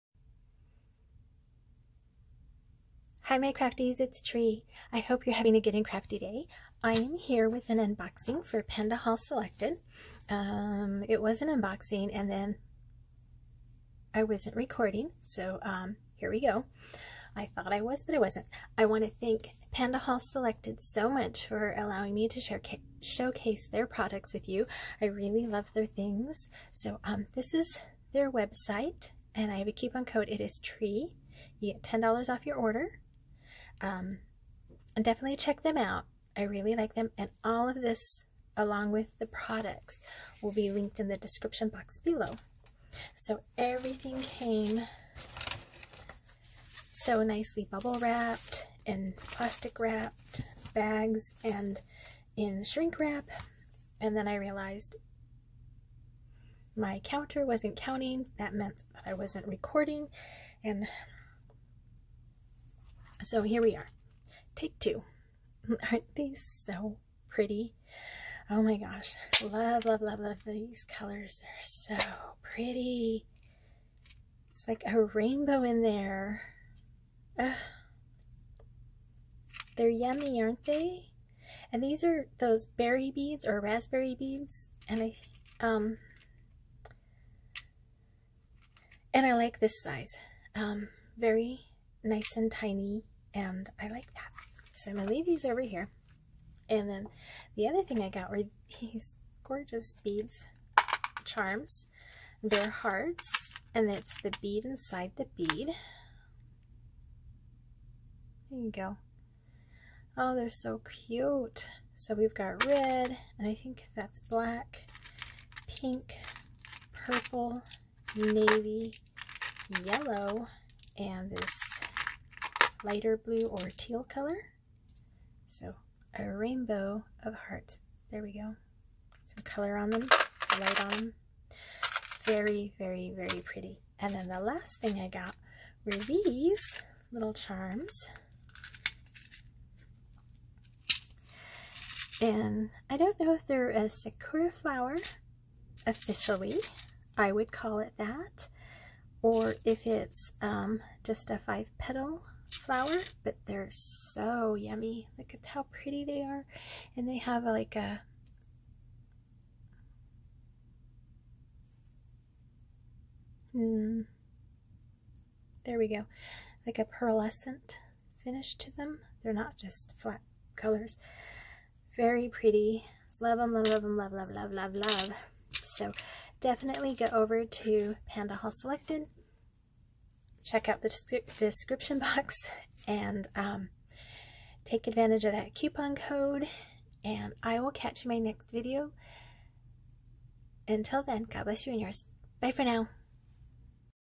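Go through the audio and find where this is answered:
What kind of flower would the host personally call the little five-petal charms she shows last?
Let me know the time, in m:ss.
2:23.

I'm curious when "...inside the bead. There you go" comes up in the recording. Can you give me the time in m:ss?
1:44.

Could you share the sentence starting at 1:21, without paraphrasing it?
And these are those berry beads or raspberry beads.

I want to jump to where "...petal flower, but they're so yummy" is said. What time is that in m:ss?
2:31.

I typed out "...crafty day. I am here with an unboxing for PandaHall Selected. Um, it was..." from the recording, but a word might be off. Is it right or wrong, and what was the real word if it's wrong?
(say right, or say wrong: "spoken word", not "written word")
right.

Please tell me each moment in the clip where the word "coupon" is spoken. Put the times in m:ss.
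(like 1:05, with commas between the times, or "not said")
0:29, 3:05.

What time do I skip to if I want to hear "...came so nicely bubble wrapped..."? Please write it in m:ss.
0:44.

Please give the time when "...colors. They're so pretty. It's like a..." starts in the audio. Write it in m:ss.
1:10.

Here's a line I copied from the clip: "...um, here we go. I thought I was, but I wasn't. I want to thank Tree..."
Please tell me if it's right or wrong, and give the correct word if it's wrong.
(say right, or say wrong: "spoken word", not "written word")
wrong: "PandaHall", not "Tree".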